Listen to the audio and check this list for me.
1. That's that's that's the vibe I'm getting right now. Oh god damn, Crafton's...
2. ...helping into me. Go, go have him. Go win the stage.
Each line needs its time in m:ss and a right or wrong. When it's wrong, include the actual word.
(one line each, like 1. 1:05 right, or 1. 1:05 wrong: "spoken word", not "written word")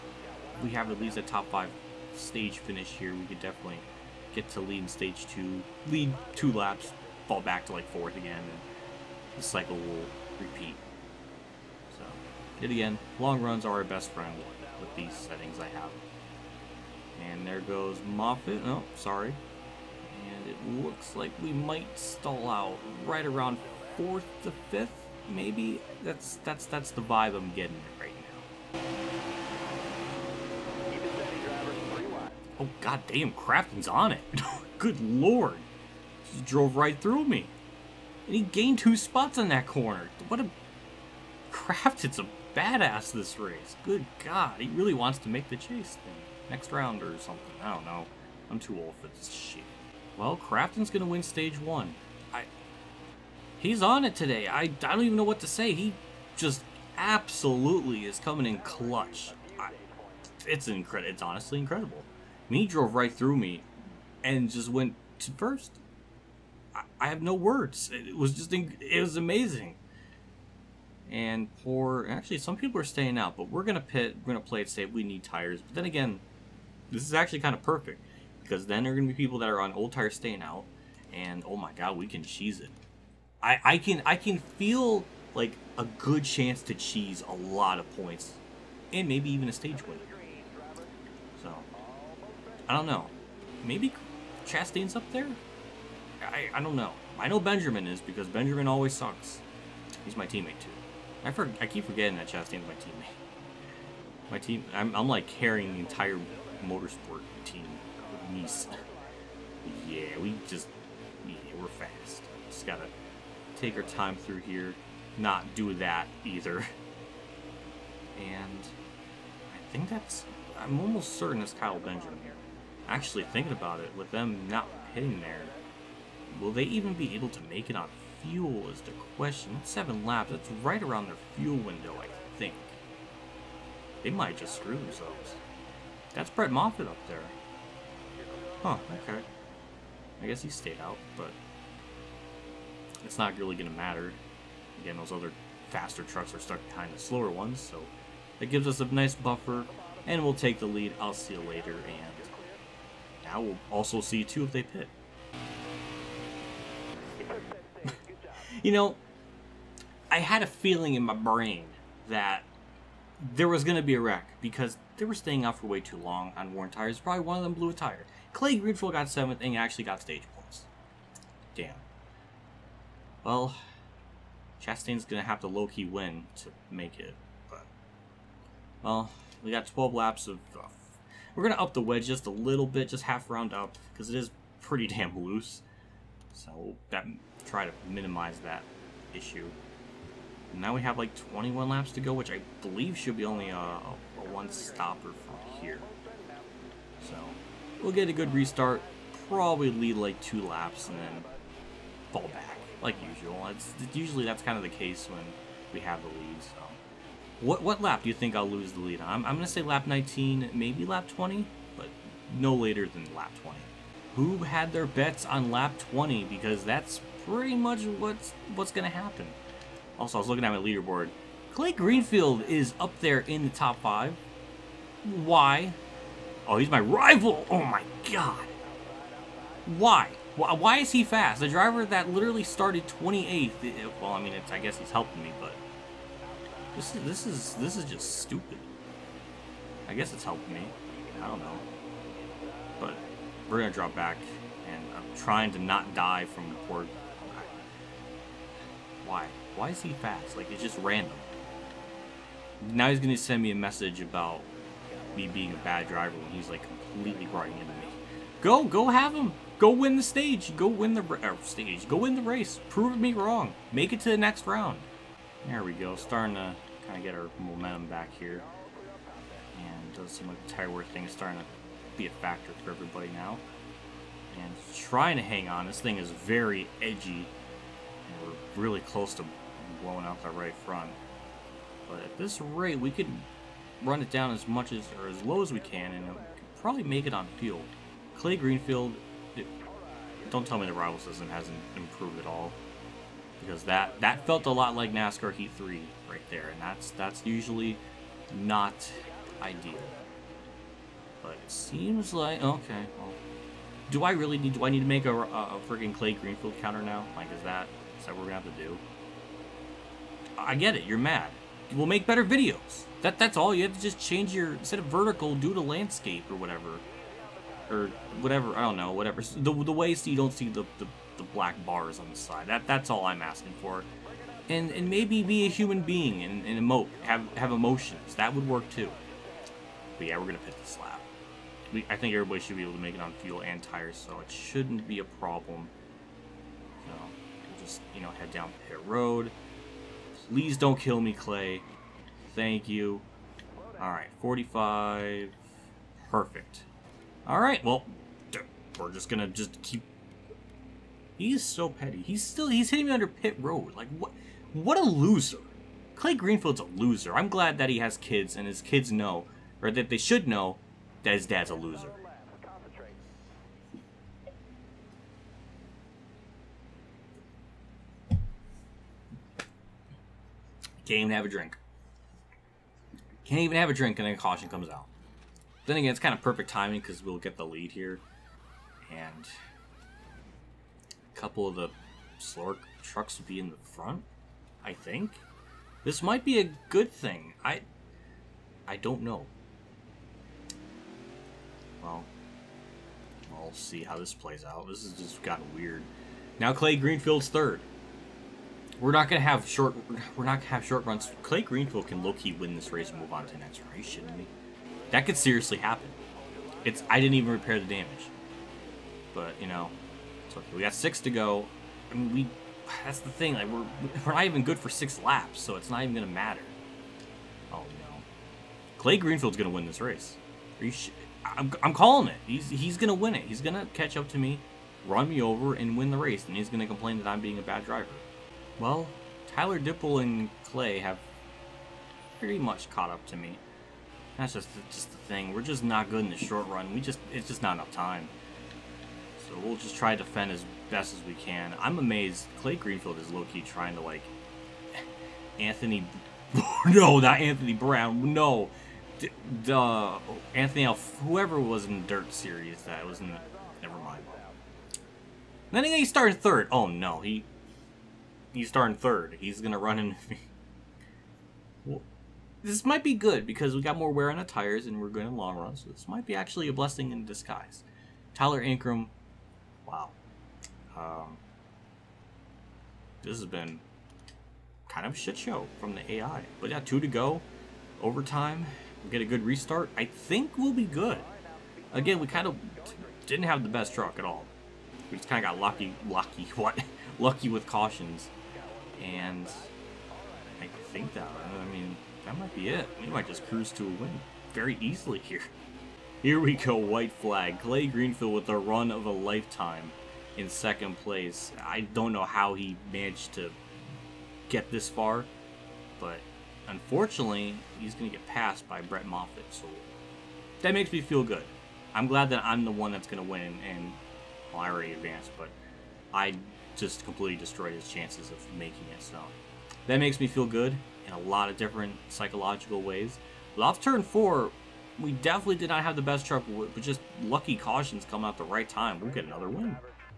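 1. 0:26 right
2. 4:17 wrong: "running", not "helping".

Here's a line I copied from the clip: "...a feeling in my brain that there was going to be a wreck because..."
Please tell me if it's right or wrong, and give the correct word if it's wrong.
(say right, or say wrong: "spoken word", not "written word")
right.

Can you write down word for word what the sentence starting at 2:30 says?
I'll see you later, and now we'll also see, too, if they pit.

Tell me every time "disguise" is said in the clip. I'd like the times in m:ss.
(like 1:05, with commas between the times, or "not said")
7:47.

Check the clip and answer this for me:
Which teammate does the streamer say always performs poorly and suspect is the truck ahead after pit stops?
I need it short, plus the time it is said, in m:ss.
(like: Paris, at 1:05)
Kyle Benjamin, at 2:01.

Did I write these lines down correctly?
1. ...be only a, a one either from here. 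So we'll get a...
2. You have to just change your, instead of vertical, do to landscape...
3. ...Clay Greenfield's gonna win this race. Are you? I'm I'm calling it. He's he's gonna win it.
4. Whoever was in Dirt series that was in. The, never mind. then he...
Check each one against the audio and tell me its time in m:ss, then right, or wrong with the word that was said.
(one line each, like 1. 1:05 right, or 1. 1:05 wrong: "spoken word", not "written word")
1. 3:13 wrong: "stopper", not "either"
2. 5:13 right
3. 6:58 right
4. 7:30 right.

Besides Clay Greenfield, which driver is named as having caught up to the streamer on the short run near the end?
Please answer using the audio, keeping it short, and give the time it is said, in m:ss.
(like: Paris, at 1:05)
Tyler Dippel, at 7:09.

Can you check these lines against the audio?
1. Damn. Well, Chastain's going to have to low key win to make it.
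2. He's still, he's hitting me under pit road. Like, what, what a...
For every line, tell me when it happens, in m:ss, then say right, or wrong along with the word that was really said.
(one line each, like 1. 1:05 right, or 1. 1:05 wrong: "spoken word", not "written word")
1. 2:51 right
2. 5:51 right.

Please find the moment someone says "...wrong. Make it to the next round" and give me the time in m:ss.
4:23.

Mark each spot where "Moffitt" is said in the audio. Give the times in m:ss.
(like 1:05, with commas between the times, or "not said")
0:18, 2:16, 8:28.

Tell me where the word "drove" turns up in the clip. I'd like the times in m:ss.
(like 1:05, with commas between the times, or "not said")
0:36, 1:02.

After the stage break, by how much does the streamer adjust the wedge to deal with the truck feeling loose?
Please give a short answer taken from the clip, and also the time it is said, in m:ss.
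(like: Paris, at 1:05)
half round, at 3:03.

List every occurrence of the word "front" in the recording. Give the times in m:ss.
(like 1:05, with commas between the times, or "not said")
4:40, 6:23.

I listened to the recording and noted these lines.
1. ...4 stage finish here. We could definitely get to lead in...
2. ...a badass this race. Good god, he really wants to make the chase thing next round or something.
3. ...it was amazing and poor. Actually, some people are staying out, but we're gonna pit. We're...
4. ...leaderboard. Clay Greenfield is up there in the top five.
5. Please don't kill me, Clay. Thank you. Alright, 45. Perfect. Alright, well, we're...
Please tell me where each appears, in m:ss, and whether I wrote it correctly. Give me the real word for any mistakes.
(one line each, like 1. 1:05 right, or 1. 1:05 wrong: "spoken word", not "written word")
1. 0:01 wrong: "5", not "4"
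2. 0:42 right
3. 1:08 right
4. 3:40 right
5. 5:40 right.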